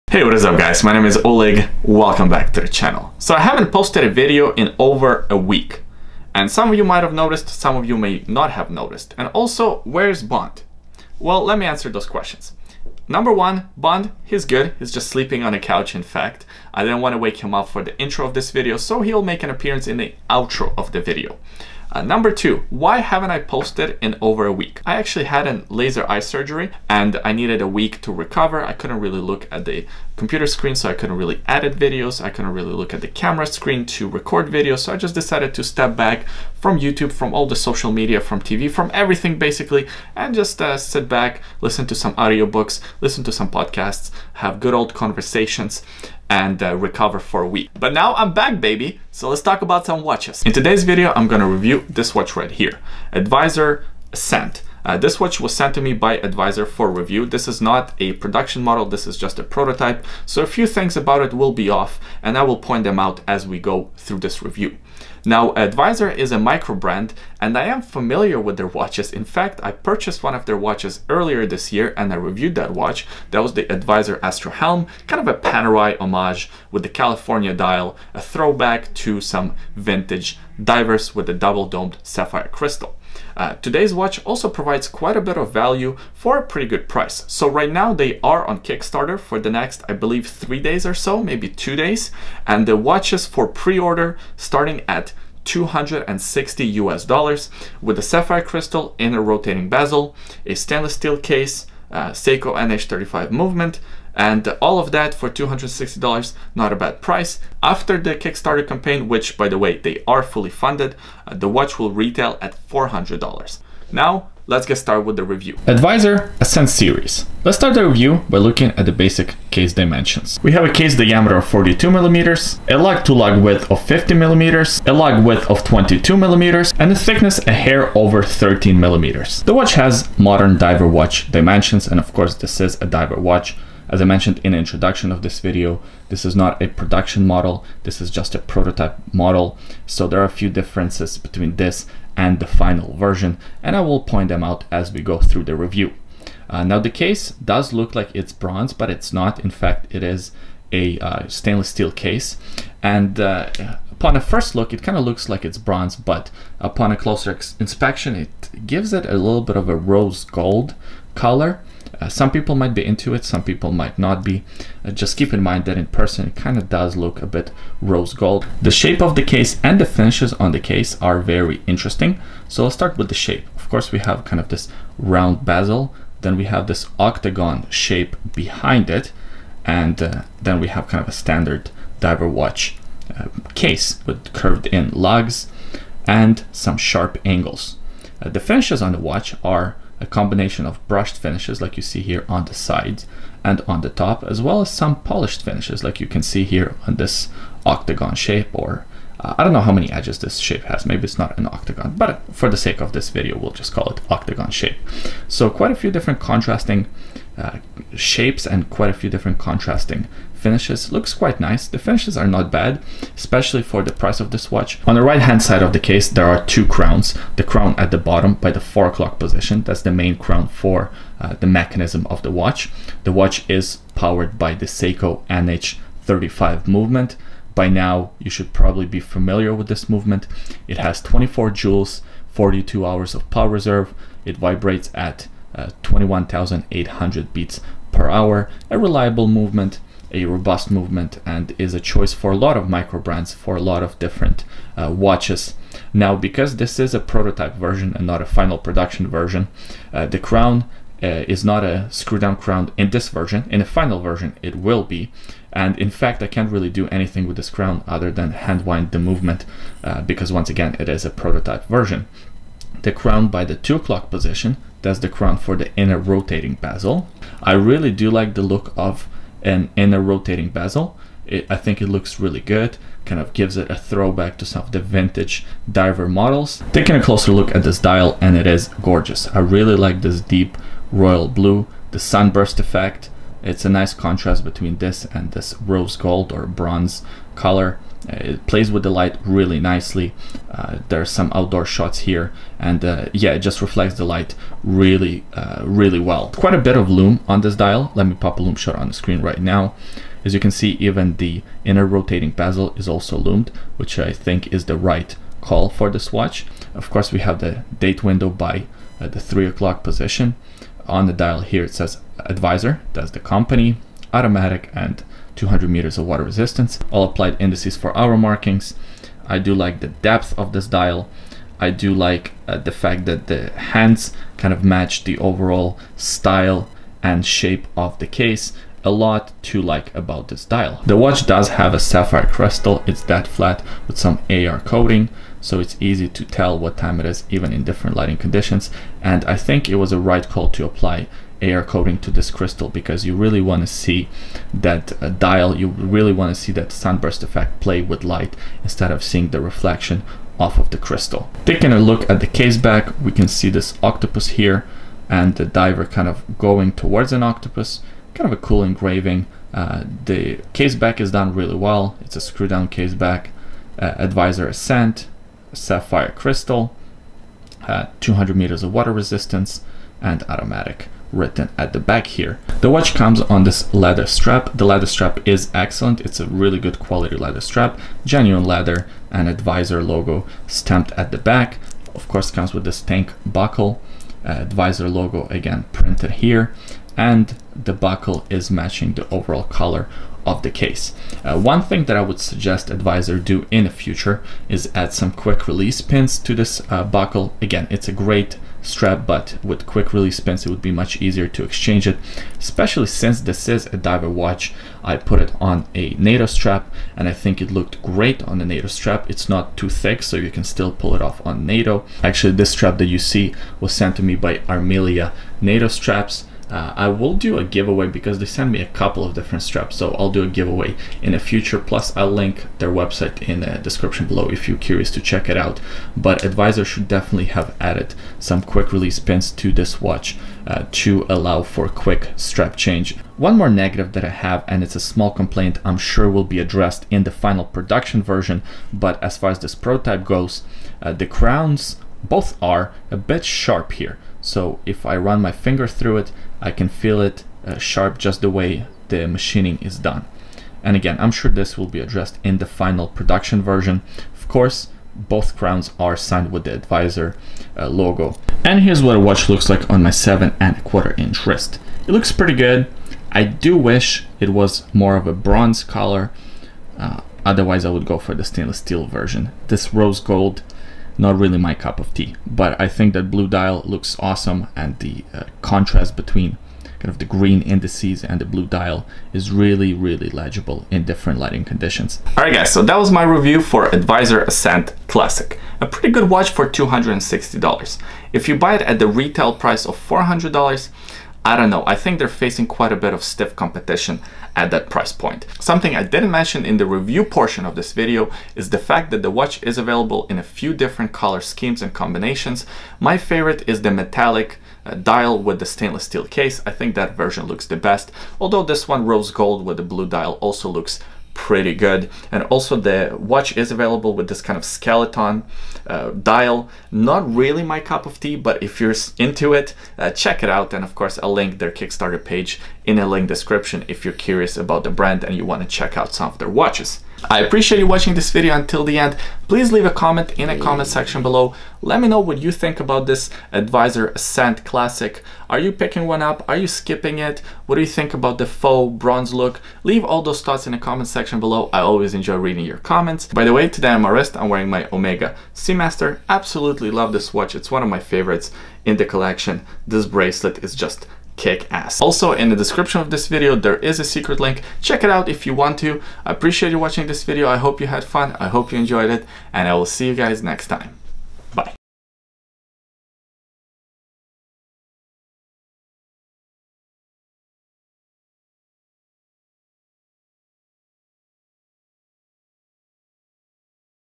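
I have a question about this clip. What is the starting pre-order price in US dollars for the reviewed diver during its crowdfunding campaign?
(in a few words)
$260.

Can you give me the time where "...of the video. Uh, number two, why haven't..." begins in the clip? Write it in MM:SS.
00:20.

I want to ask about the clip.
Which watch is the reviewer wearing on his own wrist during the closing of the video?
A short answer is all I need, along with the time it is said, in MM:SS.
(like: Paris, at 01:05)
Omega Seamaster, at 09:04.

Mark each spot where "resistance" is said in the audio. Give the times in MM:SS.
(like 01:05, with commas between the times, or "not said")
05:16, 06:08.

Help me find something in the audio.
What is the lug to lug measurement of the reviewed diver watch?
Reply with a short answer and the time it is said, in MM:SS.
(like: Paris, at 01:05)
50 millimeters, at 02:03.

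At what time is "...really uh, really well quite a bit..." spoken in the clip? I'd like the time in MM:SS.
04:54.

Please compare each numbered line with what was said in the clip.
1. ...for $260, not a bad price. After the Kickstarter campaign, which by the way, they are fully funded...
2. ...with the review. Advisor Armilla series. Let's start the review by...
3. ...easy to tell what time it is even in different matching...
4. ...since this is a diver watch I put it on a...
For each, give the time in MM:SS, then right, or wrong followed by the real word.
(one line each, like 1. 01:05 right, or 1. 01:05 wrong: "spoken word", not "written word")
1. 01:45 right
2. 01:55 wrong: "Ascent", not "Armilla"
3. 05:35 wrong: "lighting", not "matching"
4. 06:42 right.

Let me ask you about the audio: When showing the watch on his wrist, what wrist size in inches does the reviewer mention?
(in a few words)
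7.25 inches.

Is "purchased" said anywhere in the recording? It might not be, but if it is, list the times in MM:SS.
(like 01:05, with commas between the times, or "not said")
01:09.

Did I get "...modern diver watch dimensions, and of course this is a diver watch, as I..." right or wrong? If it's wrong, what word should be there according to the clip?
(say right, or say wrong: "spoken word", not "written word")
right.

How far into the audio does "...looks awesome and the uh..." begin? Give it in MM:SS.
07:53.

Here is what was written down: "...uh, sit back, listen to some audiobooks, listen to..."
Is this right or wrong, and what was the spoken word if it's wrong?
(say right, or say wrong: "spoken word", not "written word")
right.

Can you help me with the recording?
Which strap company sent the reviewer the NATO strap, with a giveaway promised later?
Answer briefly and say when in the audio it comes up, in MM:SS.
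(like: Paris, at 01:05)
Armilla, at 06:54.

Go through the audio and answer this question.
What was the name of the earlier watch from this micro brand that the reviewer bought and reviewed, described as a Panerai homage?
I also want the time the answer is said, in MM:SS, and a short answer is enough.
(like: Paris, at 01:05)
Advisor AstroHelm, at 01:13.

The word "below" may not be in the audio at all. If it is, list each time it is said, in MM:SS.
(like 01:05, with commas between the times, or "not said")
07:04, 08:51, 09:01.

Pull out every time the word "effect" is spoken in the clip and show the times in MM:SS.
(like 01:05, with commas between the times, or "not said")
04:42, 05:47.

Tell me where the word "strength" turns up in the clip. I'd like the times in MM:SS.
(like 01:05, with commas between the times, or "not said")
not said.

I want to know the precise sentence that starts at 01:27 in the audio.
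So right now they are on Kickstarter for the next, I believe, three days or so, maybe two days.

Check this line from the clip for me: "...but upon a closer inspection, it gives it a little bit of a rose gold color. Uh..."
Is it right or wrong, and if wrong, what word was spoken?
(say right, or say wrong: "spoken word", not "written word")
right.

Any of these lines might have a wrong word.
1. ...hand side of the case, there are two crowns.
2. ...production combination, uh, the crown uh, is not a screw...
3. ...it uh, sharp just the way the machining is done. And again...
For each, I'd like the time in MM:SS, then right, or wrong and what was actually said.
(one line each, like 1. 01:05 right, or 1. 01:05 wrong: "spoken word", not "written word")
1. 03:35 right
2. 04:08 wrong: "version", not "combination"
3. 07:26 right.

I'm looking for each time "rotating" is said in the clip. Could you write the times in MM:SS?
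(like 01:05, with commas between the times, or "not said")
01:39, 04:25, 04:30, 05:01.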